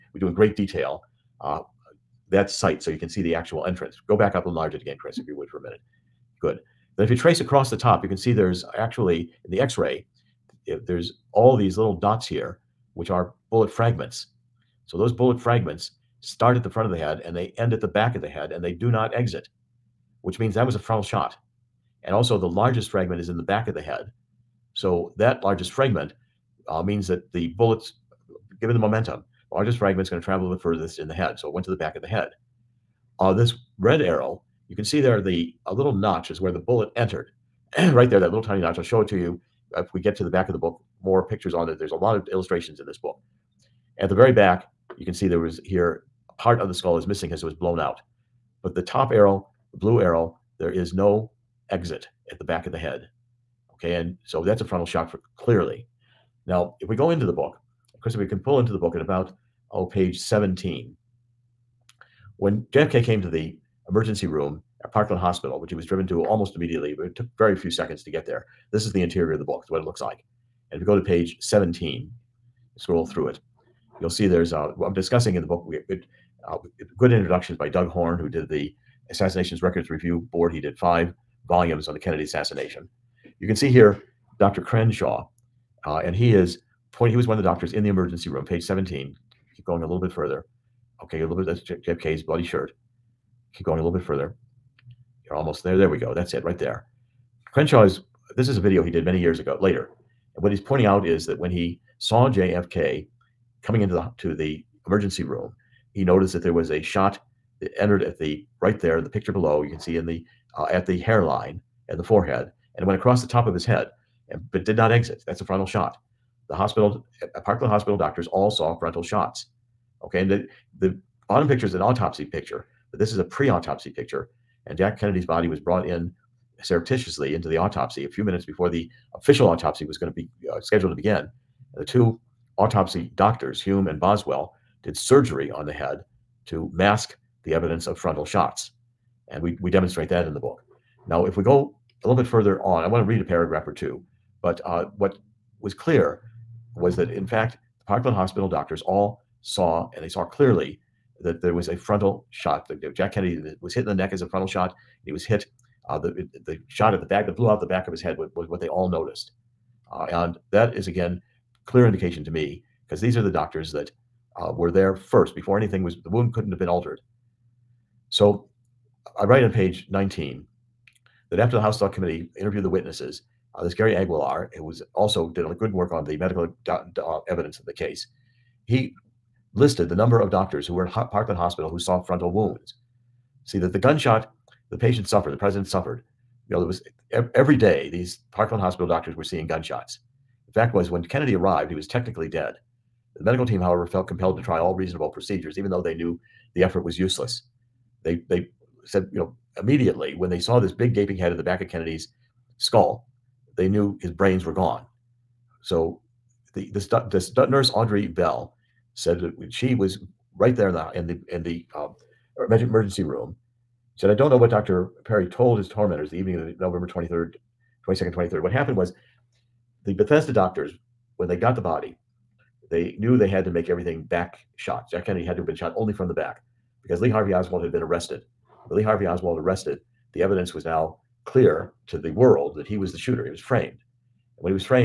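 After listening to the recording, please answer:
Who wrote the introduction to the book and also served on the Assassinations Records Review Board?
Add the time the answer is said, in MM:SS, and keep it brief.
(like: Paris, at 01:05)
Doug Horne, at 01:17.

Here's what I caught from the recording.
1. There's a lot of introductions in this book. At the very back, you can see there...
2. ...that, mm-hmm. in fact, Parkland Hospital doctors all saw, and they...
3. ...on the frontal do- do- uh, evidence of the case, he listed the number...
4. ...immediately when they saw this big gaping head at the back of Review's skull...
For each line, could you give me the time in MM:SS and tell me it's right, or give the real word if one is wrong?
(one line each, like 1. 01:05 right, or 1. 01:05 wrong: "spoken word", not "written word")
1. 00:41 wrong: "illustrations", not "introductions"
2. 02:26 right
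3. 02:55 wrong: "medical", not "frontal"
4. 03:19 wrong: "Kennedy", not "Review".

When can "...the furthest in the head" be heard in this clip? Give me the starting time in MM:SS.
00:30.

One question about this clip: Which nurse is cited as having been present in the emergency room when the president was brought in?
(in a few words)
Audrey Bell.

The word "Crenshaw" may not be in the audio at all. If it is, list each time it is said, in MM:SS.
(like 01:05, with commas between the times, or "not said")
01:24, 01:37.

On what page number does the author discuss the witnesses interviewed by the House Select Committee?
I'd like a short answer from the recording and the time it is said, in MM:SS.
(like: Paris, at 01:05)
19, at 02:49.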